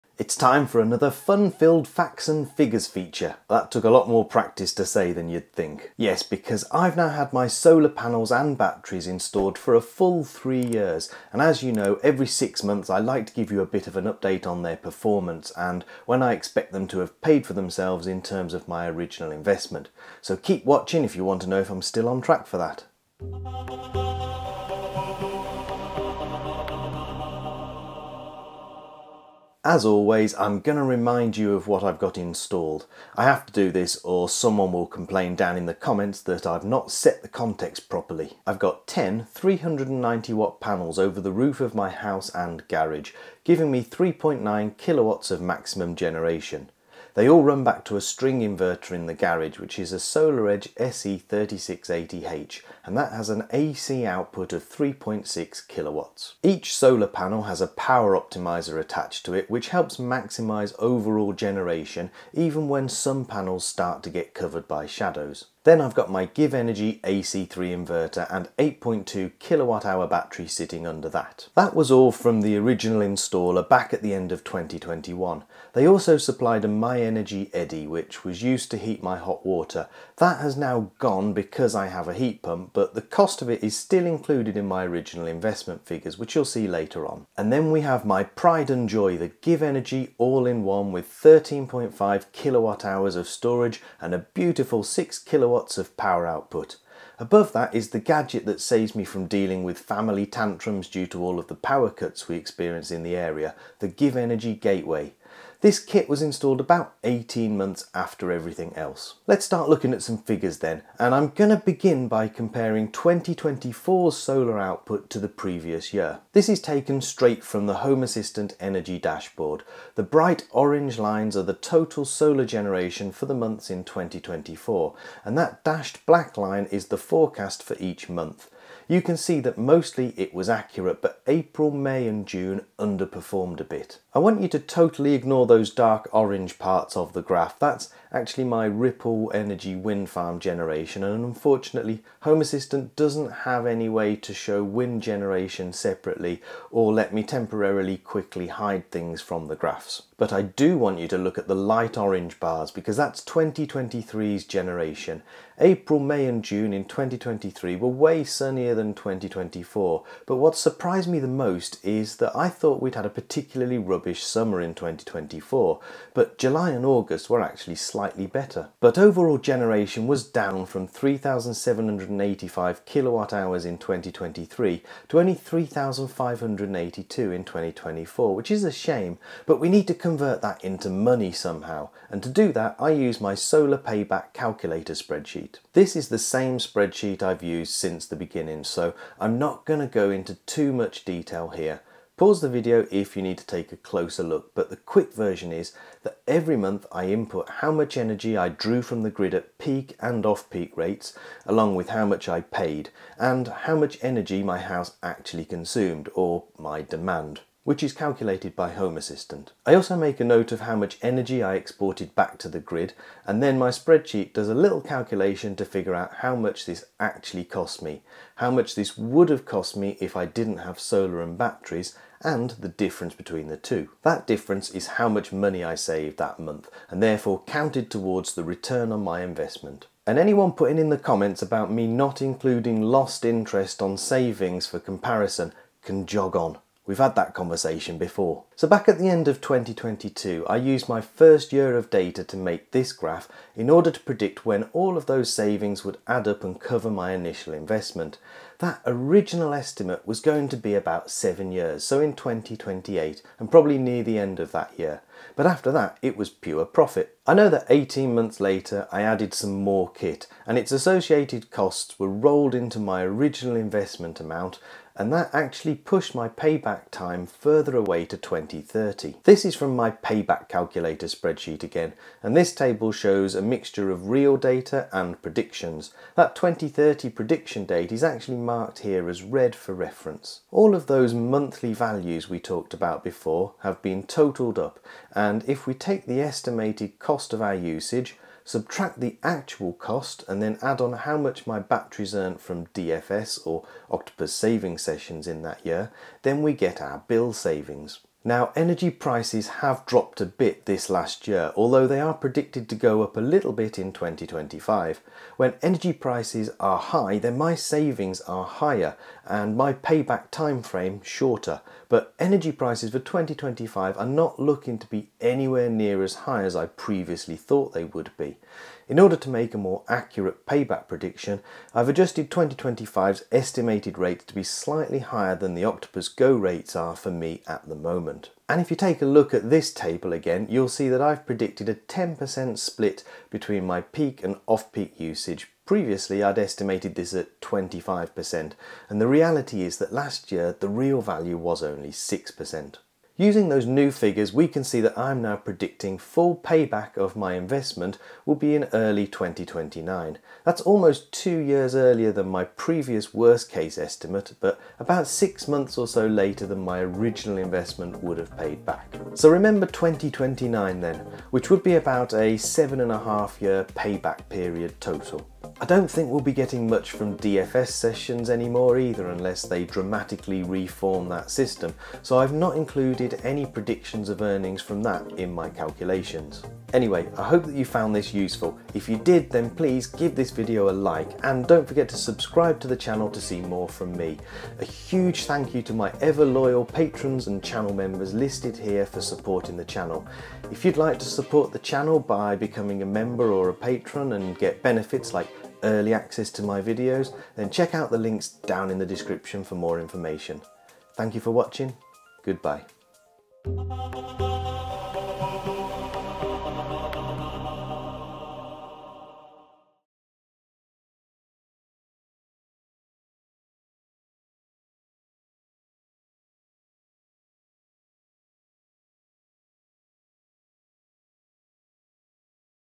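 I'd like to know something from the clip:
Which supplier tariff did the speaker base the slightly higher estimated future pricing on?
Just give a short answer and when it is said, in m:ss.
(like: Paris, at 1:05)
Octopus Go, at 5:25.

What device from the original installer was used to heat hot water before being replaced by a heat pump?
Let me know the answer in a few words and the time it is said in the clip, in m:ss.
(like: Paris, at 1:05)
myenergi eddi, at 1:16.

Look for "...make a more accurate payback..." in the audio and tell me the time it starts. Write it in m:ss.
5:19.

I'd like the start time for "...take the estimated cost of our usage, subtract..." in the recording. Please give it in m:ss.
4:45.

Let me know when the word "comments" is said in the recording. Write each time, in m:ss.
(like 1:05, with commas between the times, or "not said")
0:35, 3:50.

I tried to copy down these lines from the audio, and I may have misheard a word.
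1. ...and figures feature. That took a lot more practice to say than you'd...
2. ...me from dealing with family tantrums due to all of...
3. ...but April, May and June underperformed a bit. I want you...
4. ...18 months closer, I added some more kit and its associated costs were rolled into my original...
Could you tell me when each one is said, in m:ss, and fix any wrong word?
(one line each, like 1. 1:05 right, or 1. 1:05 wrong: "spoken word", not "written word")
1. 0:02 right
2. 1:38 right
3. 2:11 right
4. 4:17 wrong: "later", not "closer".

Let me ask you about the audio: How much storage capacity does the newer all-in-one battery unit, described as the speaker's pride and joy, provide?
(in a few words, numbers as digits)
13.5 kilowatt hours.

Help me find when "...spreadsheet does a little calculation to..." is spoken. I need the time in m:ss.
3:33.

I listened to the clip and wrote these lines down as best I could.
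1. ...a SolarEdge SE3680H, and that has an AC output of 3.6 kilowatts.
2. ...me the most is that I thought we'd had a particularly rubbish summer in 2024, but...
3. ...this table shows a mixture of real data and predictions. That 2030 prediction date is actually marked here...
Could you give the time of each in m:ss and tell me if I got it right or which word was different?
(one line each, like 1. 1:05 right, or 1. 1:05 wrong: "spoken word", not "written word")
1. 0:49 right
2. 2:41 right
3. 4:32 right.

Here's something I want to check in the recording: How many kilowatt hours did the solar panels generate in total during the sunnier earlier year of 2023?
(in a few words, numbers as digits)
3,785.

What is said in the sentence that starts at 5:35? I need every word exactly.
Previously, I'd estimated this at 25%, and the reality is that last year, the real value was only 6%.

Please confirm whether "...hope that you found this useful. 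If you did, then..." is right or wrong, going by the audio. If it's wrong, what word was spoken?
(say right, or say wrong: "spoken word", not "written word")
right.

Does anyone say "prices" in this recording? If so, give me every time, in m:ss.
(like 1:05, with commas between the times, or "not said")
4:58, 5:05, 5:12.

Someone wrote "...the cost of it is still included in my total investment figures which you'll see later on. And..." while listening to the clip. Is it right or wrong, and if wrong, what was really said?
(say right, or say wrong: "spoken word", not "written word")
wrong: "original", not "total".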